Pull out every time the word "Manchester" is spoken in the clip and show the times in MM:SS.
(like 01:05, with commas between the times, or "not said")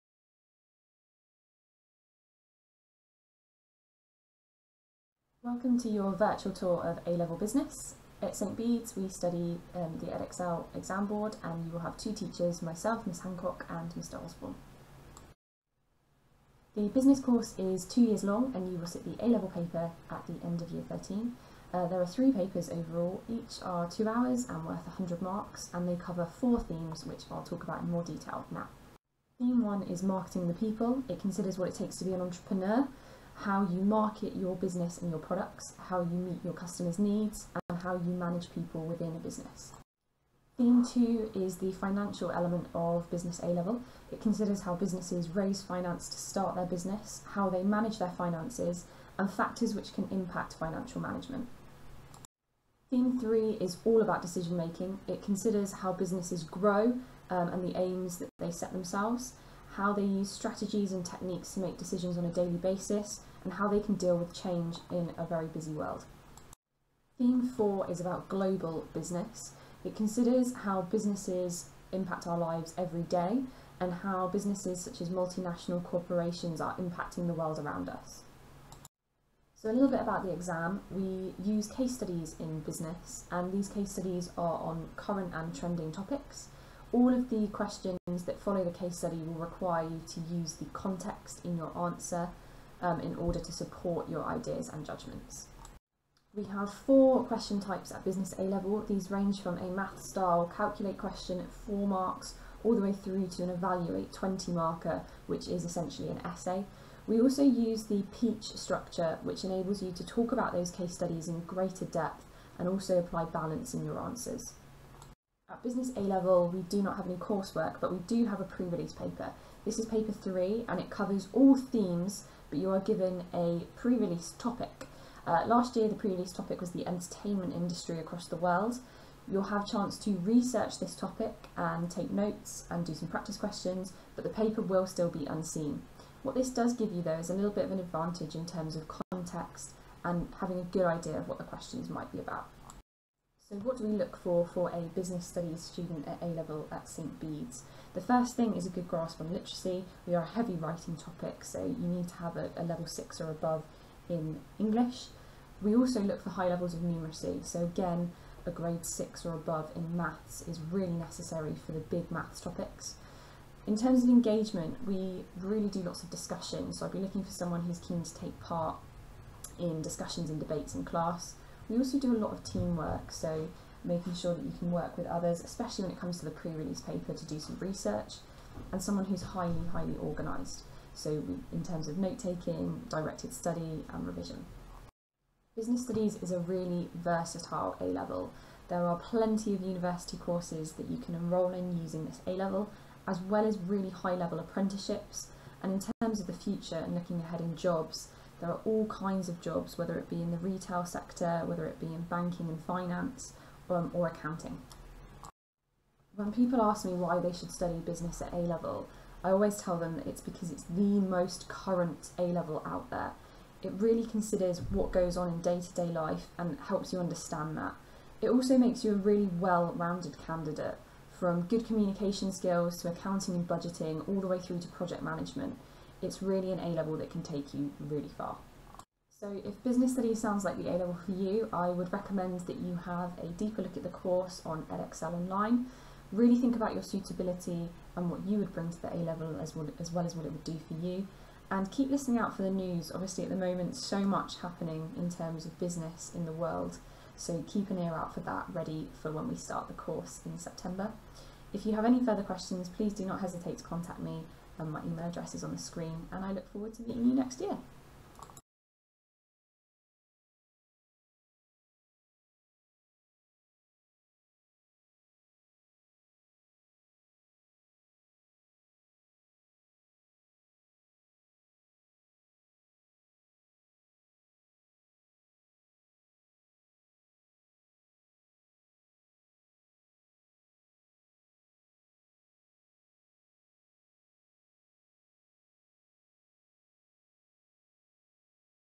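not said.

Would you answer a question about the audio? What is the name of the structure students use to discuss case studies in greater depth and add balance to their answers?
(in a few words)
PEACH.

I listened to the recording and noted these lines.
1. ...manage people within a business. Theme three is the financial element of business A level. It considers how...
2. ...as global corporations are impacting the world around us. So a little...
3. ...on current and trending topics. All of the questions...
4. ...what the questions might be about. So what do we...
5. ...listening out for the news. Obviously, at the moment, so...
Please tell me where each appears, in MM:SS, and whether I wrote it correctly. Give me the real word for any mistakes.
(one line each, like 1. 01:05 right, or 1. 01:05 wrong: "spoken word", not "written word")
1. 00:38 wrong: "two", not "three"
2. 01:15 wrong: "multinational", not "global"
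3. 01:24 right
4. 02:21 right
5. 04:01 right.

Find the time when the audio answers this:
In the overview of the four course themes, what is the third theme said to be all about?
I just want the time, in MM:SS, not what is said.
00:54.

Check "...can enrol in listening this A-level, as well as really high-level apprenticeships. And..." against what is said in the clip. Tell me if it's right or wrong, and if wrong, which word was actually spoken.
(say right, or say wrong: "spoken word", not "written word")
wrong: "using", not "listening".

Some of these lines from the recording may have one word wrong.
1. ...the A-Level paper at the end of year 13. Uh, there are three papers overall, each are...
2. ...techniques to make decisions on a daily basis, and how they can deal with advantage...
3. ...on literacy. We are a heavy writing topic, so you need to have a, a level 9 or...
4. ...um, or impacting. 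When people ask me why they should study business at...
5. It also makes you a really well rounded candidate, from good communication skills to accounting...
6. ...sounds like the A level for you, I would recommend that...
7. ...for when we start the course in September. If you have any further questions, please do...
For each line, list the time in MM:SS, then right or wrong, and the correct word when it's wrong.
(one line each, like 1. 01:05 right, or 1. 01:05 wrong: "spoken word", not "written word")
1. 00:19 right
2. 01:01 wrong: "change", not "advantage"
3. 02:29 wrong: "6", not "9"
4. 03:23 wrong: "accounting", not "impacting"
5. 03:38 right
6. 03:50 right
7. 04:09 right.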